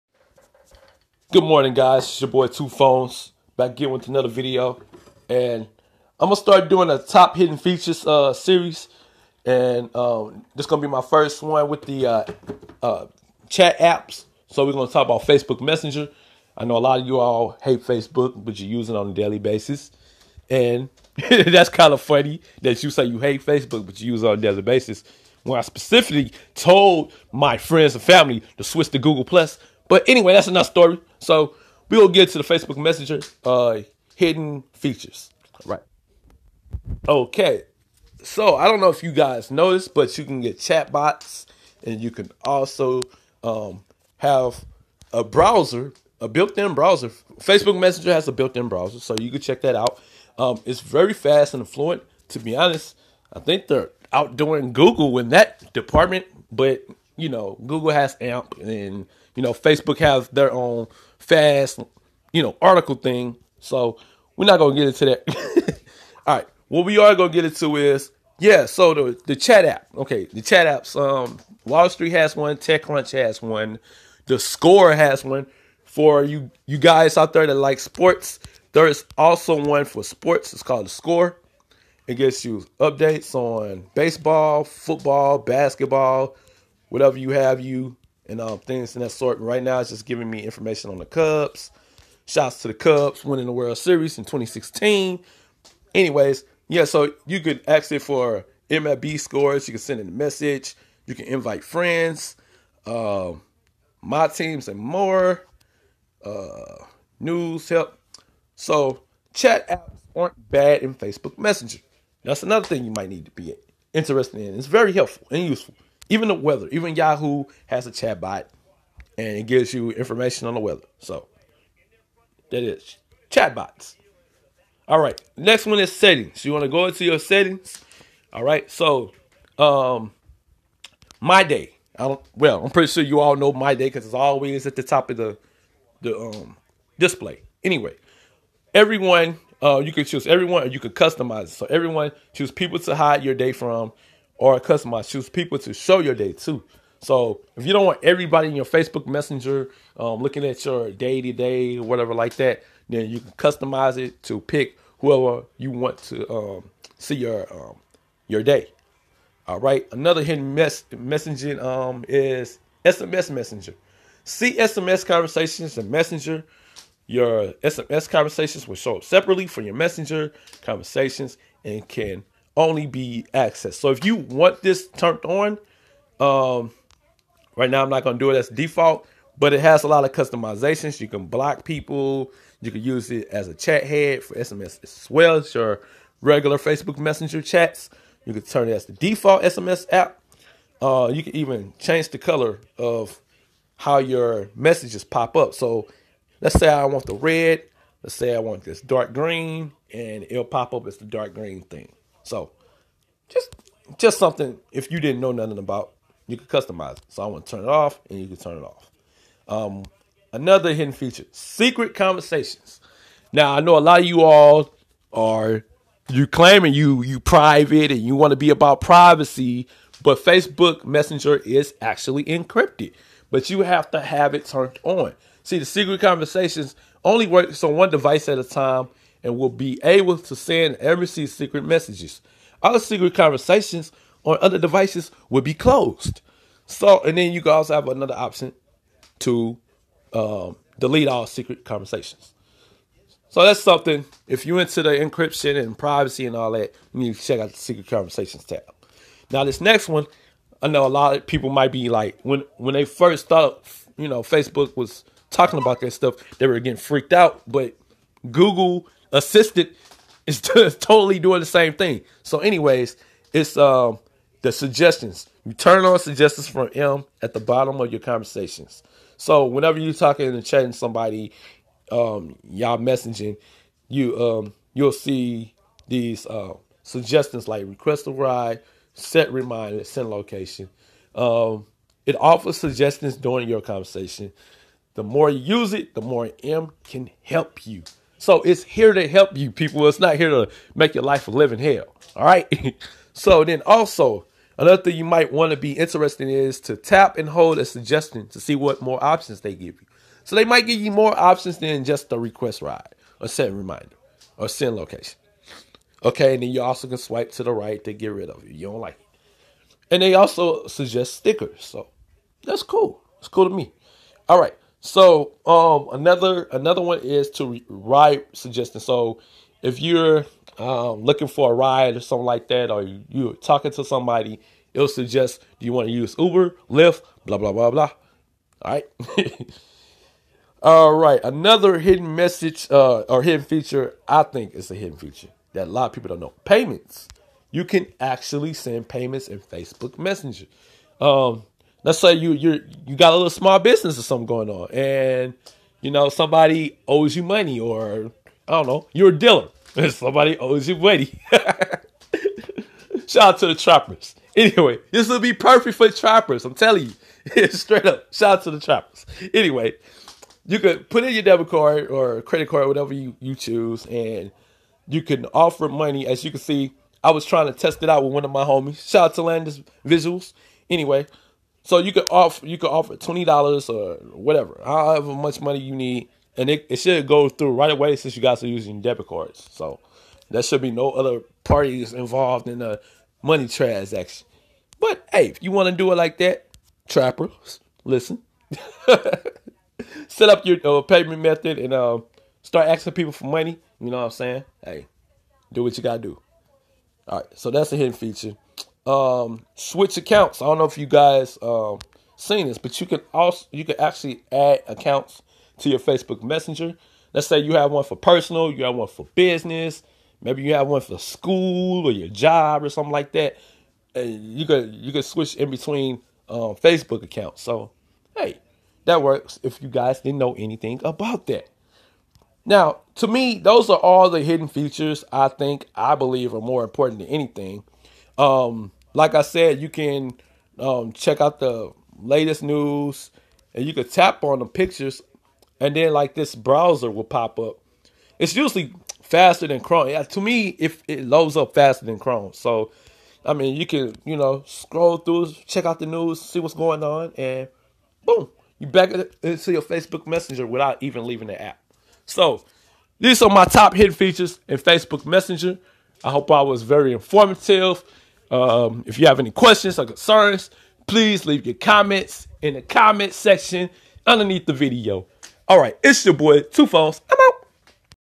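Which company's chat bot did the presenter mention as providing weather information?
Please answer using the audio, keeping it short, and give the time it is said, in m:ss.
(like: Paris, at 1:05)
Yahoo, at 1:56.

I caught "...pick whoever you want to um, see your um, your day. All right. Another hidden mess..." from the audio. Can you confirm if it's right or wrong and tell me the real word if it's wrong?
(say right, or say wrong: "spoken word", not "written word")
right.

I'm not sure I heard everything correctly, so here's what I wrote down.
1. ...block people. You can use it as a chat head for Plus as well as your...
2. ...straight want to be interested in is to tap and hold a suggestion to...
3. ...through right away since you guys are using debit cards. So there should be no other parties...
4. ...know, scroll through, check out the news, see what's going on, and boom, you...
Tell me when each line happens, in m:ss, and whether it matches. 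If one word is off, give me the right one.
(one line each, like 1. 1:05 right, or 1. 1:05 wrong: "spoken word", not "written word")
1. 3:01 wrong: "SMS", not "Plus"
2. 4:55 wrong: "might", not "straight"
3. 6:17 right
4. 7:24 right.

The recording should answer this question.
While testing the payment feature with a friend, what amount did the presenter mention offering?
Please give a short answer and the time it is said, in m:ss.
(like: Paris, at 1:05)
$20, at 6:12.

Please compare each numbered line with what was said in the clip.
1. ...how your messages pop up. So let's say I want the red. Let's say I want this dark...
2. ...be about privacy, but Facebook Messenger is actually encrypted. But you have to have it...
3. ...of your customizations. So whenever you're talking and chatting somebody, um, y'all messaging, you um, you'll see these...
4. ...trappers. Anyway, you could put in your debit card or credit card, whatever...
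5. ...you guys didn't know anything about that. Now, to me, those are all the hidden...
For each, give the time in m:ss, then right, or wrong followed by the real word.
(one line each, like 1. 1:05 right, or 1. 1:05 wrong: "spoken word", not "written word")
1. 3:13 right
2. 3:38 right
3. 4:27 wrong: "conversations", not "customizations"
4. 5:58 right
5. 6:59 right.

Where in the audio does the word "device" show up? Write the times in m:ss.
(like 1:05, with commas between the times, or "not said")
3:47, 3:54.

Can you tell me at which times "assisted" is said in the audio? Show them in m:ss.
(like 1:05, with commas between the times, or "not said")
4:19.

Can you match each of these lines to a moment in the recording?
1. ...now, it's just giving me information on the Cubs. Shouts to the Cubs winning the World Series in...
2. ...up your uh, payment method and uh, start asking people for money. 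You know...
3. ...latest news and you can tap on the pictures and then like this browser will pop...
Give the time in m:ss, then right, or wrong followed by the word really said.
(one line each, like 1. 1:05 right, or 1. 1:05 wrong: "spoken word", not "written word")
1. 1:29 right
2. 6:30 right
3. 7:12 right.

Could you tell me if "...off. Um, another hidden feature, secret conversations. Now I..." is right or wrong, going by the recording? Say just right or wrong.
right.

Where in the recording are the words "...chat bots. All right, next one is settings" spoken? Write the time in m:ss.
2:03.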